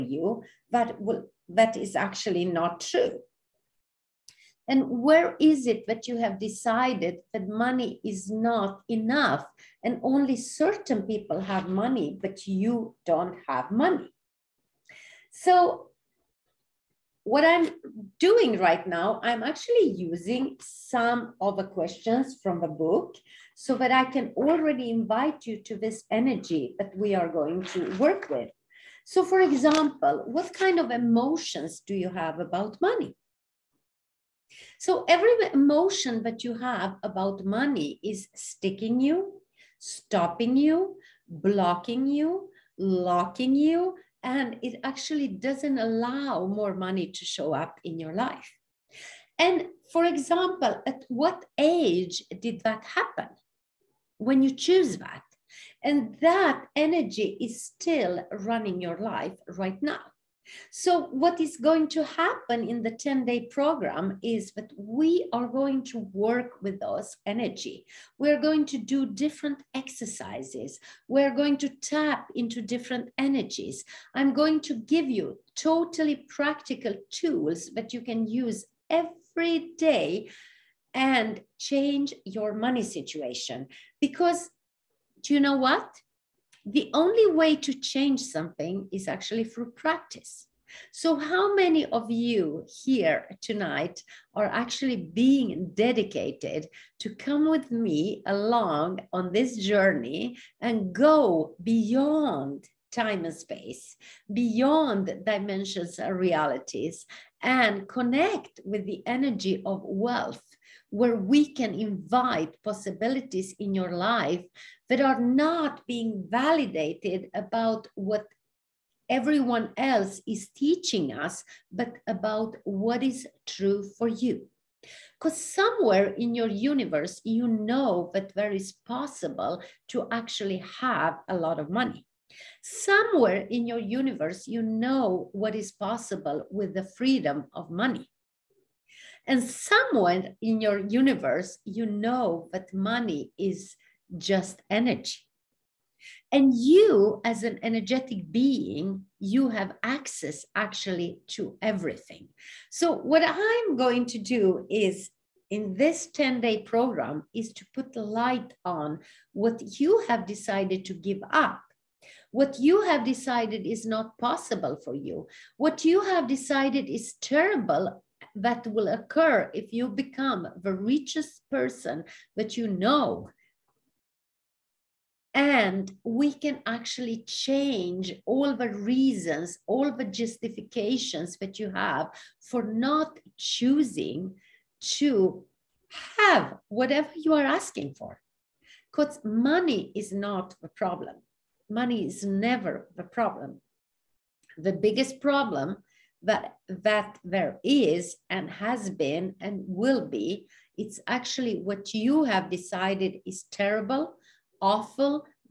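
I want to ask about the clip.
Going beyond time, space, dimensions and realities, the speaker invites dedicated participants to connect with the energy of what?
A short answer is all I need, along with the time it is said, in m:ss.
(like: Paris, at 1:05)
wealth, at 1:49.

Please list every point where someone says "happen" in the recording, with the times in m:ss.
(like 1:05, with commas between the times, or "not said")
0:52, 1:02.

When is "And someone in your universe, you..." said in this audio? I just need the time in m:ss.
2:19.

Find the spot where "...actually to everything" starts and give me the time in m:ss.
2:30.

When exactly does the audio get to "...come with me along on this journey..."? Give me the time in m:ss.
1:37.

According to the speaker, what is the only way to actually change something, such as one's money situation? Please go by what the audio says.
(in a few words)
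practice.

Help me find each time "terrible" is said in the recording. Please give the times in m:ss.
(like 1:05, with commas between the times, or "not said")
2:47, 3:23.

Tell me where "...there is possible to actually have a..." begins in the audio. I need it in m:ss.
2:08.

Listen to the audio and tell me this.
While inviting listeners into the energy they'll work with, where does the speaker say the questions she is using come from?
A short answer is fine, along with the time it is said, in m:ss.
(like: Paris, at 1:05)
the book, at 0:22.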